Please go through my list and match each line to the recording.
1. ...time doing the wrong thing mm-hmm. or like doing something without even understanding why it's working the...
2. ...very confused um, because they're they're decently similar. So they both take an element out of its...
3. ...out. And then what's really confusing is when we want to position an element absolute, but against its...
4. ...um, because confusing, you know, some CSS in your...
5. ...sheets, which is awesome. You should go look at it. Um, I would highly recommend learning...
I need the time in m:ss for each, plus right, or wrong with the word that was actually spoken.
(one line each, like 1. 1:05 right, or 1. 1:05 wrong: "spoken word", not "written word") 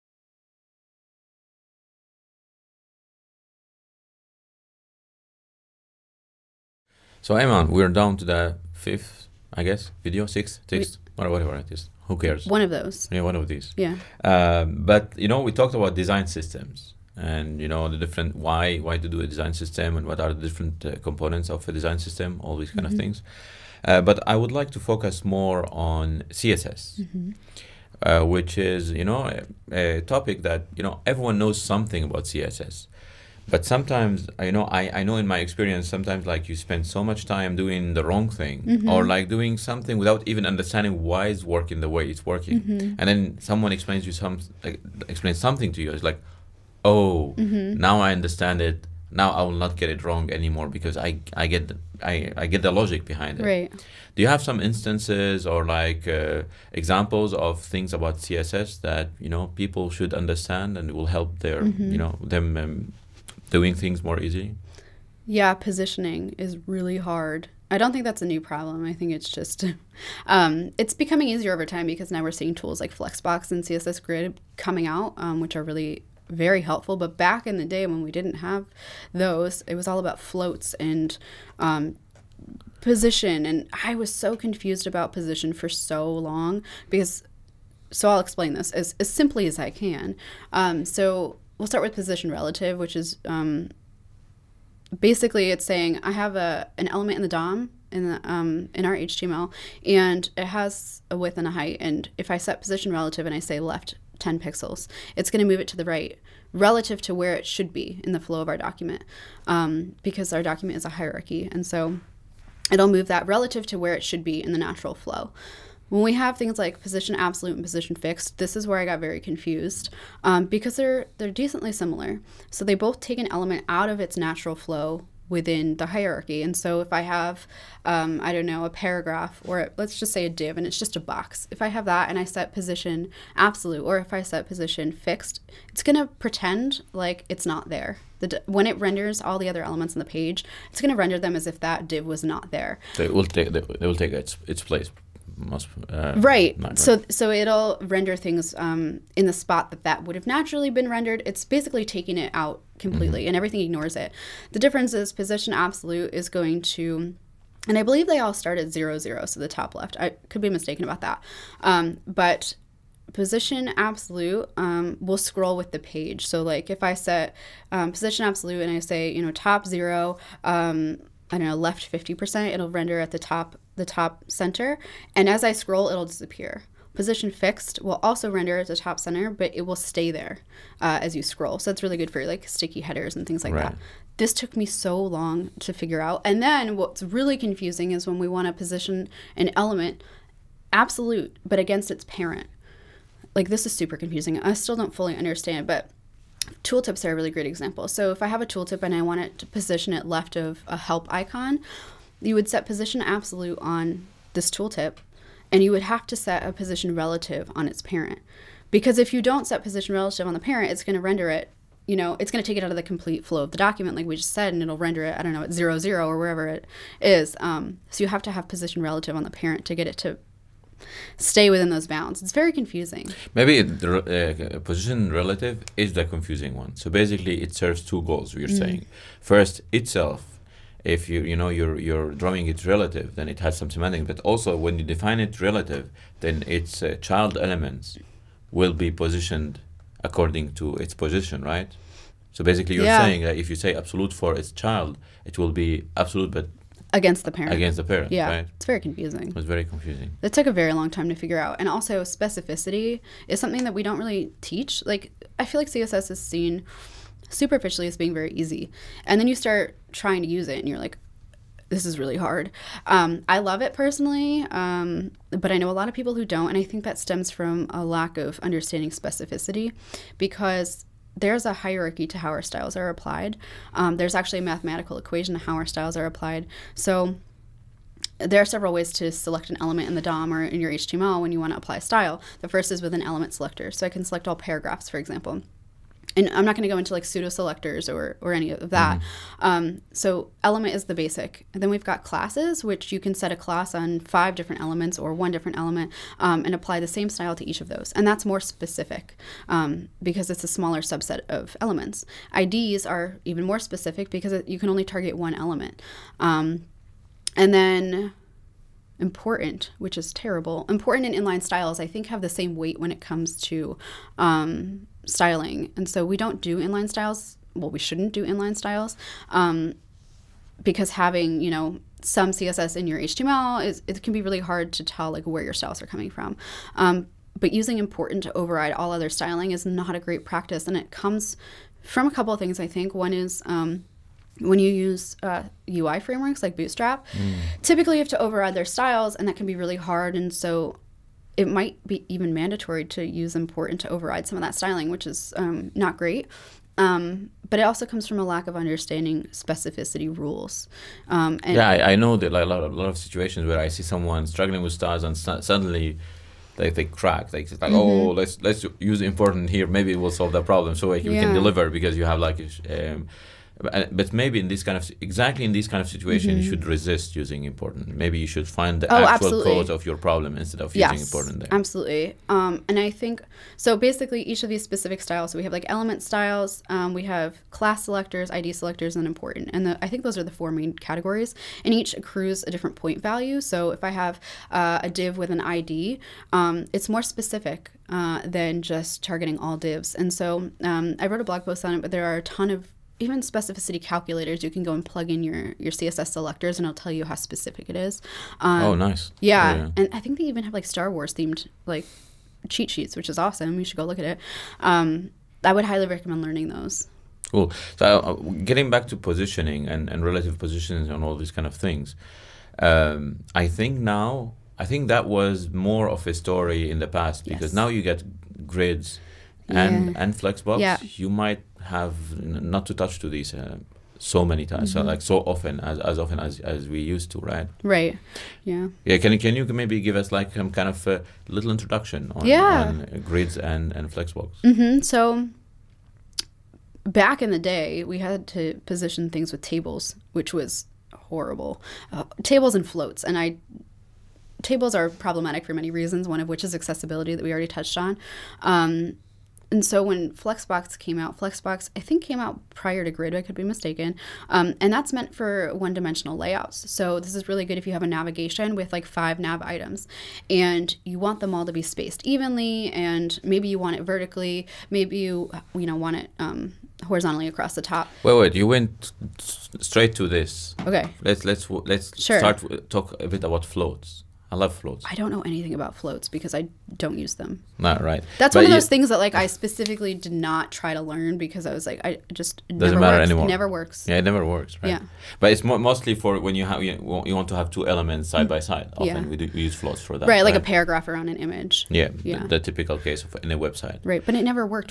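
1. 0:37 right
2. 1:58 right
3. 3:05 right
4. 5:19 wrong: "having", not "confusing"
5. 6:42 right.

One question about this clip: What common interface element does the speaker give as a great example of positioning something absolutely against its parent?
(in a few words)
tooltips.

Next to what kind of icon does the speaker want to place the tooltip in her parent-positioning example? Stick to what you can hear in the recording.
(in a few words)
help icon.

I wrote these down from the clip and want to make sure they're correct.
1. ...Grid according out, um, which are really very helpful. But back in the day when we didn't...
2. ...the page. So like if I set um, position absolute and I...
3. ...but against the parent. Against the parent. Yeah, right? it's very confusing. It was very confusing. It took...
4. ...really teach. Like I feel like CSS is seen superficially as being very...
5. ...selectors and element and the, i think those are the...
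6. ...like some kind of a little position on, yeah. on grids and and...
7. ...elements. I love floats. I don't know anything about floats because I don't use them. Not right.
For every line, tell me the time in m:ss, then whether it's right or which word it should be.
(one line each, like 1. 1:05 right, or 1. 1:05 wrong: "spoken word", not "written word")
1. 1:14 wrong: "coming", not "according"
2. 2:45 right
3. 4:06 right
4. 4:13 right
5. 6:18 wrong: "important", not "element"
6. 7:10 wrong: "introduction", not "position"
7. 7:53 wrong: "floats", not "elements".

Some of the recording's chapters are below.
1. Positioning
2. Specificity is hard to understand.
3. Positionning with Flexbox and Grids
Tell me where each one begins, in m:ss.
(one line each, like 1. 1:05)
1. 1:04
2. 4:11
3. 6:48.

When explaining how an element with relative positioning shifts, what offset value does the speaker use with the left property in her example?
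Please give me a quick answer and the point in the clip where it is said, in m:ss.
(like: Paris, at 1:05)
10 pixels, at 1:43.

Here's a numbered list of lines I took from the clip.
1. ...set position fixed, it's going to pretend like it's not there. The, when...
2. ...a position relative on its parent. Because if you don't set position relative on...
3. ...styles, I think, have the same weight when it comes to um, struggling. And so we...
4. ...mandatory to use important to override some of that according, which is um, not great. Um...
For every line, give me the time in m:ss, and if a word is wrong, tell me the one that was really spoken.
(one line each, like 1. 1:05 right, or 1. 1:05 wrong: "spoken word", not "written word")
1. 2:14 right
2. 3:26 right
3. 5:11 wrong: "styling", not "struggling"
4. 5:42 wrong: "styling", not "according".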